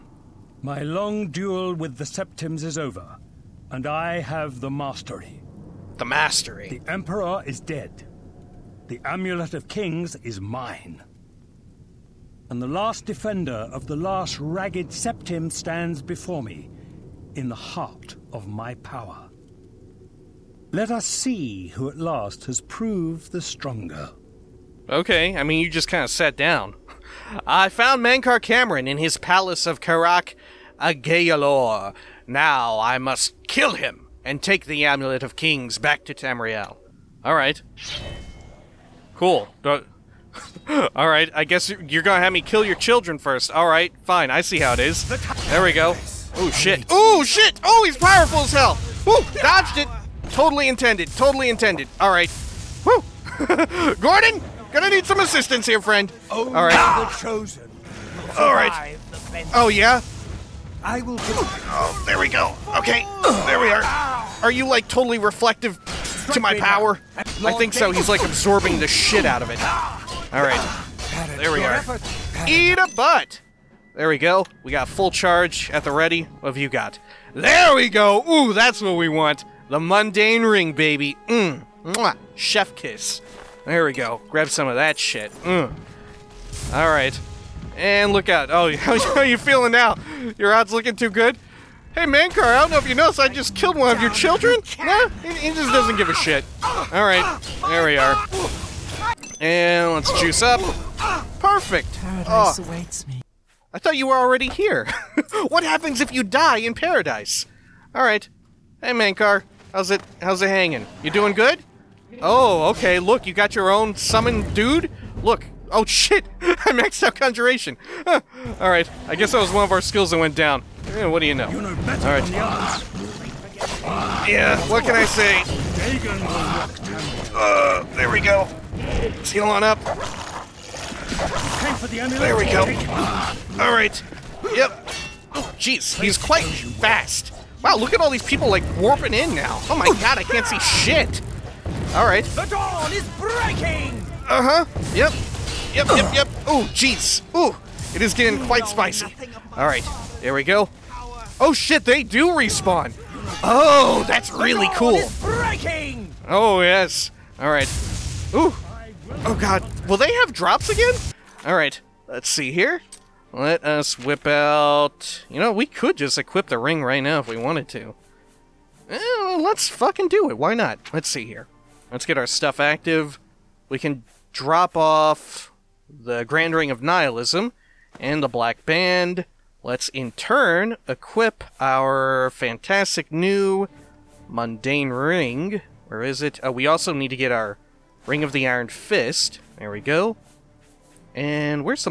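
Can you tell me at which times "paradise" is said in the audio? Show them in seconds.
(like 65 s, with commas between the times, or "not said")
101 s, 106 s.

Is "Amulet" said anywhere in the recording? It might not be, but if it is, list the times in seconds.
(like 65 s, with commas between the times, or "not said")
9 s, 34 s.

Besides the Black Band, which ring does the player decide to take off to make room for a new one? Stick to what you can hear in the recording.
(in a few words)
Grand Ring of Nihilism.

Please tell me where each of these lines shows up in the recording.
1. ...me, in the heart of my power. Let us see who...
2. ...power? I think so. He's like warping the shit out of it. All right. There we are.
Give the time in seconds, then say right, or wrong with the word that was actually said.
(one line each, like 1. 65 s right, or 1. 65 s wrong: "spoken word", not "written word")
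1. 16 s right
2. 66 s wrong: "absorbing", not "warping".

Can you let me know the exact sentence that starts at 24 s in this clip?
Okay, I mean, you just kind of sat down.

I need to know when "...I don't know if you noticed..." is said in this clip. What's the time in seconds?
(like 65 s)
92 s.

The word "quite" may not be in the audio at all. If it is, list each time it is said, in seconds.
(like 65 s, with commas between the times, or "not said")
136 s, 148 s.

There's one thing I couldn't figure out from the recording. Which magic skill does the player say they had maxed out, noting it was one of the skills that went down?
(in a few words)
Conjuration.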